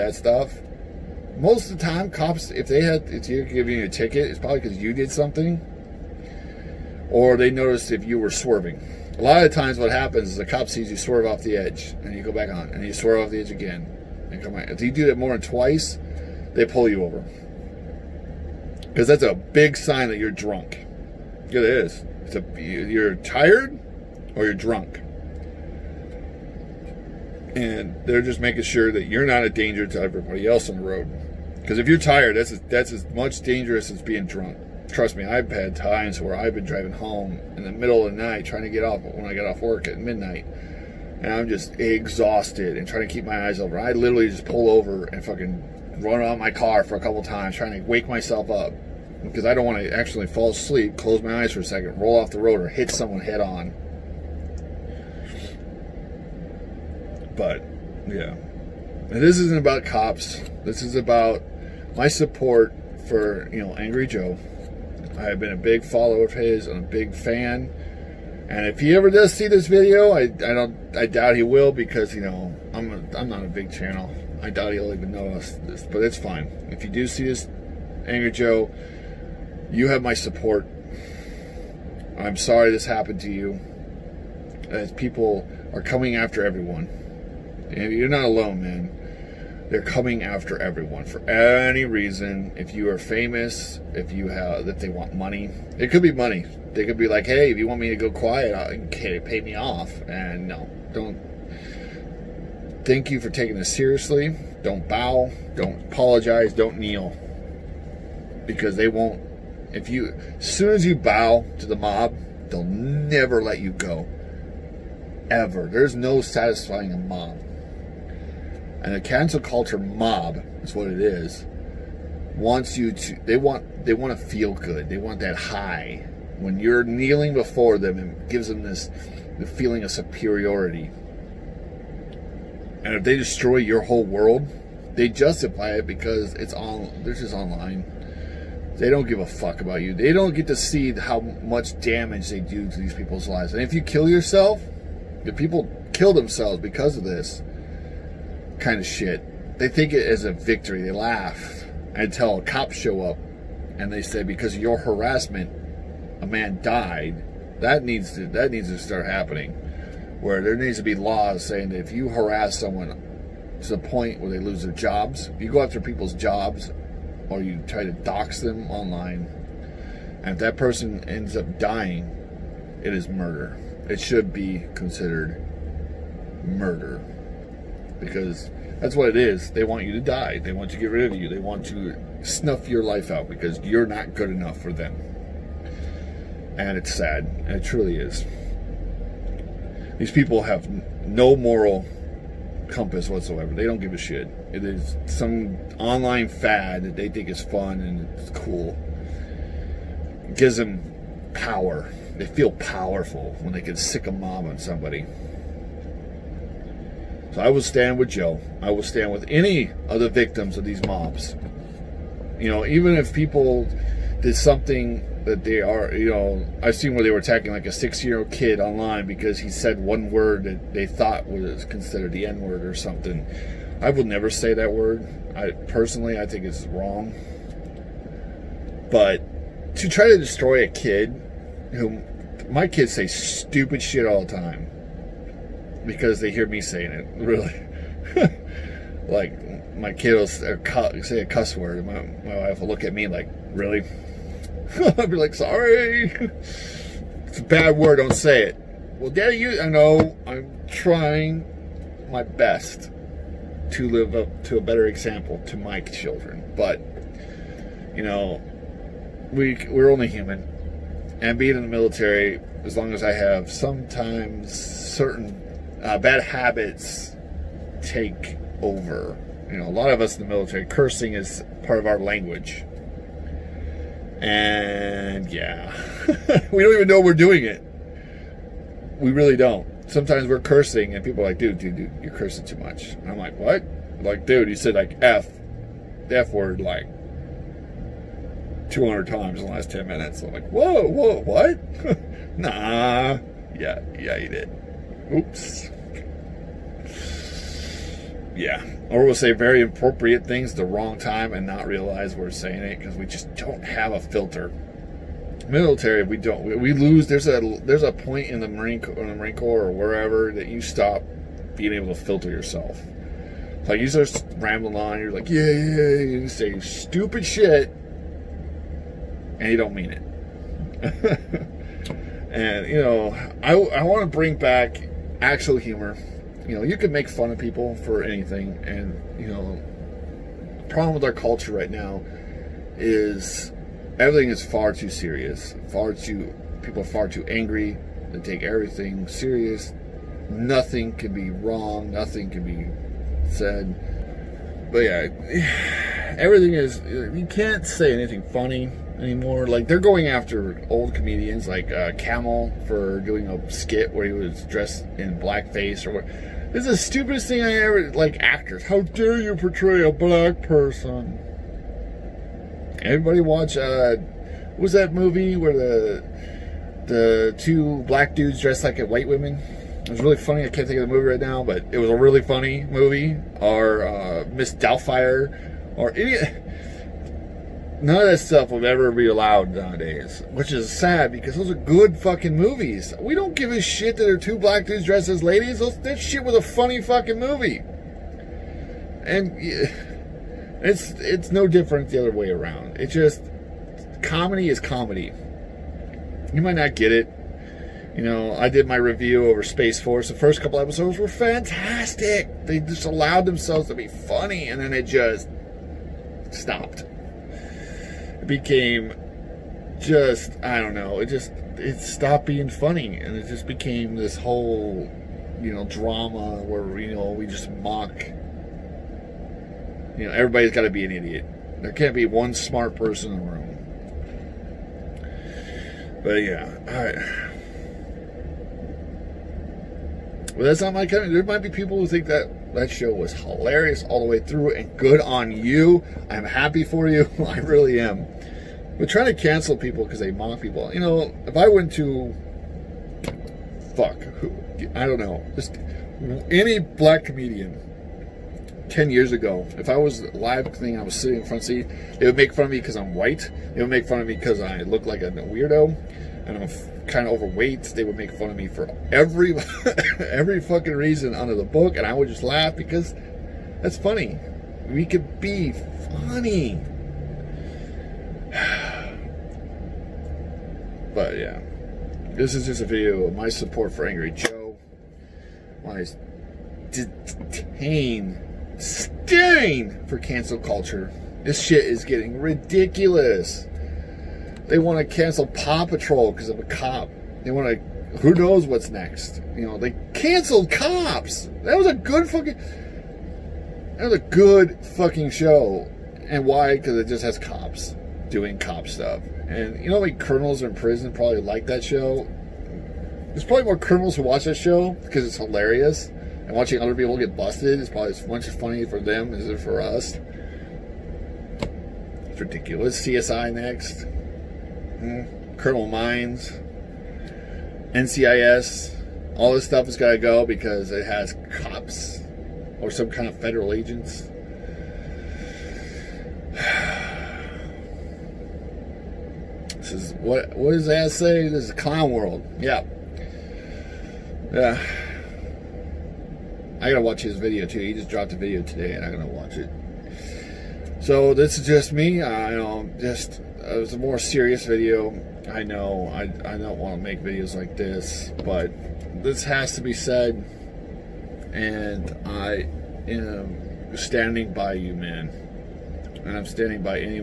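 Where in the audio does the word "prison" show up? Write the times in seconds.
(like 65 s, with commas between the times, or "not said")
500 s.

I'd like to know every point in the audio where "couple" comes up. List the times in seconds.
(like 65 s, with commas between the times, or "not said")
46 s, 400 s.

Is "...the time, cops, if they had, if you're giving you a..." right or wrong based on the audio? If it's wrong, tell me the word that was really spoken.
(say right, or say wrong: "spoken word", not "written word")
right.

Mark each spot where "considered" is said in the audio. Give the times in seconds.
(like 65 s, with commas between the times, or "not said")
174 s, 221 s.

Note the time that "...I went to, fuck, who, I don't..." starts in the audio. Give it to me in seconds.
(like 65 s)
441 s.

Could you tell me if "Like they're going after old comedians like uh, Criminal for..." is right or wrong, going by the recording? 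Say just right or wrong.
wrong.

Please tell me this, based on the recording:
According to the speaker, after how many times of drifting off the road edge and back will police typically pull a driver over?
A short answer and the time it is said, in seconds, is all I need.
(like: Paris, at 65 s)
2, at 15 s.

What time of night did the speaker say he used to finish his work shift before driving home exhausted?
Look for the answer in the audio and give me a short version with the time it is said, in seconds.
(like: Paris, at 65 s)
Midnight, at 39 s.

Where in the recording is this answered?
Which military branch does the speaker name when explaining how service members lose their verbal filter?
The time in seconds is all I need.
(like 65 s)
309 s.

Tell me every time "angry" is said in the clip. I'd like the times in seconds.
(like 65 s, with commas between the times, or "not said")
63 s, 78 s, 337 s, 473 s.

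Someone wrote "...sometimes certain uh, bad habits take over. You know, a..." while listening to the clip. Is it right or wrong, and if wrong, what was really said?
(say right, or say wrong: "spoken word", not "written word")
right.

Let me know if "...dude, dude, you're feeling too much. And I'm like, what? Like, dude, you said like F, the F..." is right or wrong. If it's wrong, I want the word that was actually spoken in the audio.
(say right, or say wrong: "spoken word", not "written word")
wrong: "cursing", not "feeling".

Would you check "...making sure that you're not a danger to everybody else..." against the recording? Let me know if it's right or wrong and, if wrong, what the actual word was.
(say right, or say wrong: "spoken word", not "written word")
right.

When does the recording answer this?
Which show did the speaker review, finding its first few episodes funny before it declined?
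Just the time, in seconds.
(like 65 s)
399 s.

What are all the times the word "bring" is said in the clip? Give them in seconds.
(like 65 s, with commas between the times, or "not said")
324 s.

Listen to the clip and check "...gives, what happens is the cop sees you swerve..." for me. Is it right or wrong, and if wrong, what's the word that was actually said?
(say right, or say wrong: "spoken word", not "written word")
wrong: "times", not "gives".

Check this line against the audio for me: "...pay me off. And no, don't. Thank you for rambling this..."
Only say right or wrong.
wrong.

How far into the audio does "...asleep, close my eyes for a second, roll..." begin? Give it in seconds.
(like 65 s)
50 s.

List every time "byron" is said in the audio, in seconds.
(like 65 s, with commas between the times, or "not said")
not said.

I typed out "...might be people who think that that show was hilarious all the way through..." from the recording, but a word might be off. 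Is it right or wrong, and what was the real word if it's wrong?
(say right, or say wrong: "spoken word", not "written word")
right.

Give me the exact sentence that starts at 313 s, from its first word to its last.
Like you start rambling on, you're like, yeah, yeah, yeah, you say stupid shit, and you don't mean it.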